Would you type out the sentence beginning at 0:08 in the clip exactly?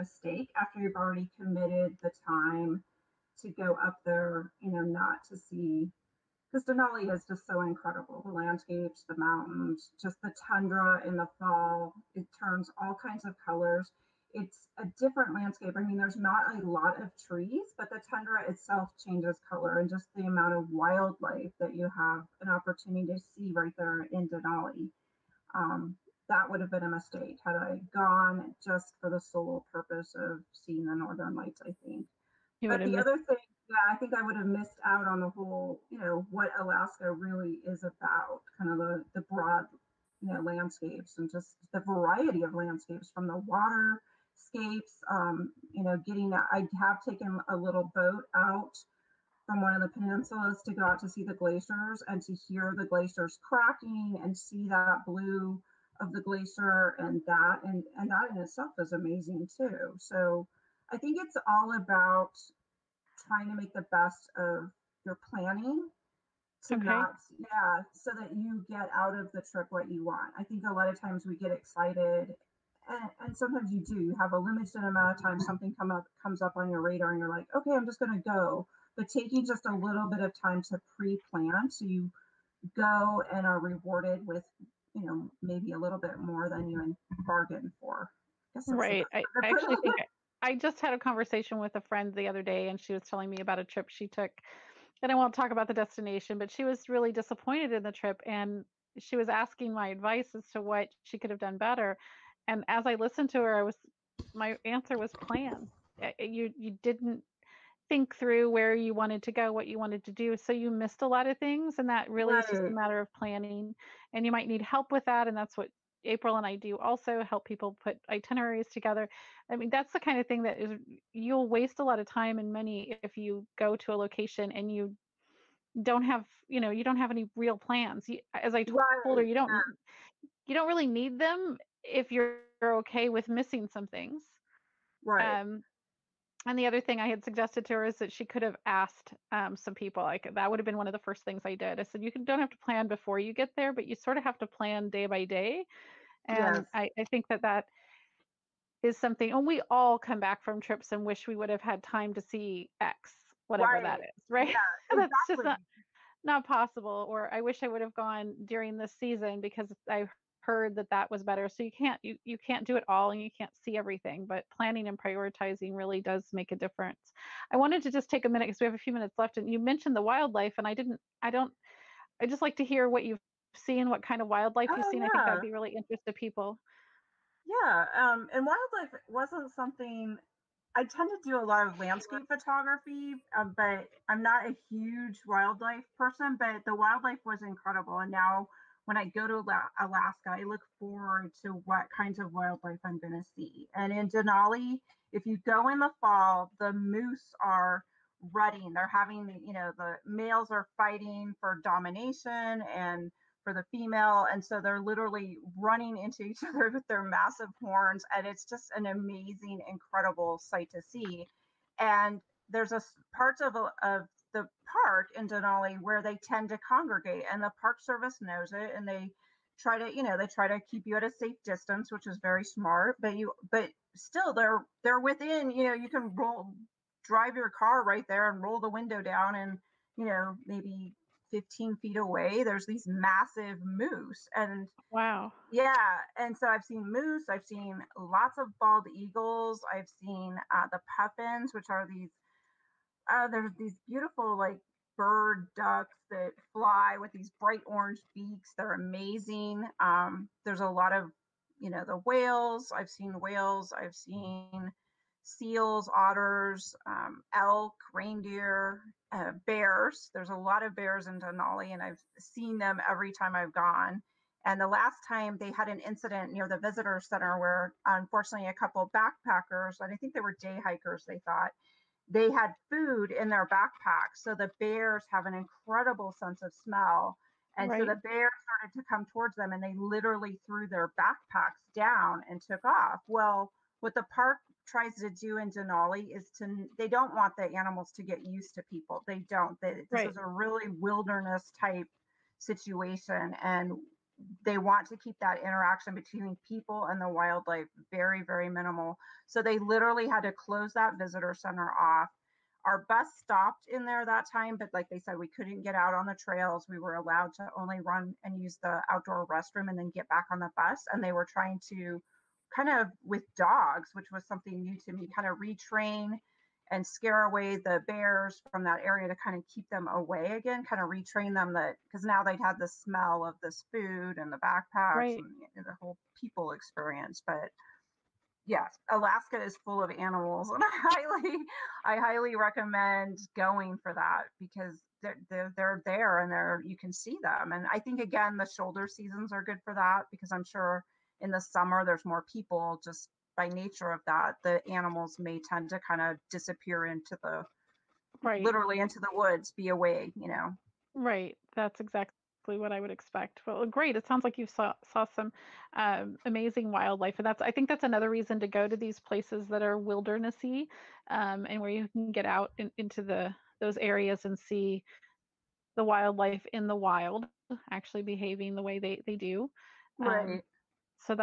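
The landscapes, the mountains, just the tundra in the fall, it turns all kinds of colors it's a different landscape.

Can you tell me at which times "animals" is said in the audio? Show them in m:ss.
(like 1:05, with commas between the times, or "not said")
4:47, 5:29, 5:44.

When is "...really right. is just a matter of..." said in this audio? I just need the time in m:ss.
1:52.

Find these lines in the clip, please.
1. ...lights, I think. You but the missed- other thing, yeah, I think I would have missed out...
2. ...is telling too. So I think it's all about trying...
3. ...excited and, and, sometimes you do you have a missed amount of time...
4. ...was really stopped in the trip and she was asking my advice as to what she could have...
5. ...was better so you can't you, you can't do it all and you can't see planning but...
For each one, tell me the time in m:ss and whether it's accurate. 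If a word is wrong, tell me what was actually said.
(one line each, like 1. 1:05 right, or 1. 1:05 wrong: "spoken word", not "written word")
1. 0:31 right
2. 0:58 wrong: "amazing", not "telling"
3. 1:11 wrong: "limited", not "missed"
4. 1:36 wrong: "disappointed", not "stopped"
5. 2:41 wrong: "everything", not "planning".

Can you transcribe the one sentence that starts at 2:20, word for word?
Like that would have been one of the first things I did.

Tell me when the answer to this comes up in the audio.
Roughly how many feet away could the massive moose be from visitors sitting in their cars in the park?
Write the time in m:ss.
3:51.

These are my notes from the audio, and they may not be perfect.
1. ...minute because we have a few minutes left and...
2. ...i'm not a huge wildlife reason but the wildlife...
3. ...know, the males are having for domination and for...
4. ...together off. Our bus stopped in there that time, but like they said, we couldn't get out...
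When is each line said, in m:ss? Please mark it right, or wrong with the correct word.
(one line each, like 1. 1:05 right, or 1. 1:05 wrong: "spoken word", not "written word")
1. 2:48 right
2. 3:04 wrong: "person", not "reason"
3. 3:19 wrong: "fighting", not "having"
4. 5:01 wrong: "center", not "together".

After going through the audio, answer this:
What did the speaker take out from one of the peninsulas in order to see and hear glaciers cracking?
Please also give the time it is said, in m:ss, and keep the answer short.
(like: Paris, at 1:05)
A little boat, at 0:47.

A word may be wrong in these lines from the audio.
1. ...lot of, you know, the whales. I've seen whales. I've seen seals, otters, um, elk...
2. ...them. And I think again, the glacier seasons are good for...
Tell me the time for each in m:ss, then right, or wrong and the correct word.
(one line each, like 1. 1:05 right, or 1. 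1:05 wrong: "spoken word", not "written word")
1. 4:10 right
2. 5:37 wrong: "shoulder", not "glacier".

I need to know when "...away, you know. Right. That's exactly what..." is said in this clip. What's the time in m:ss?
5:49.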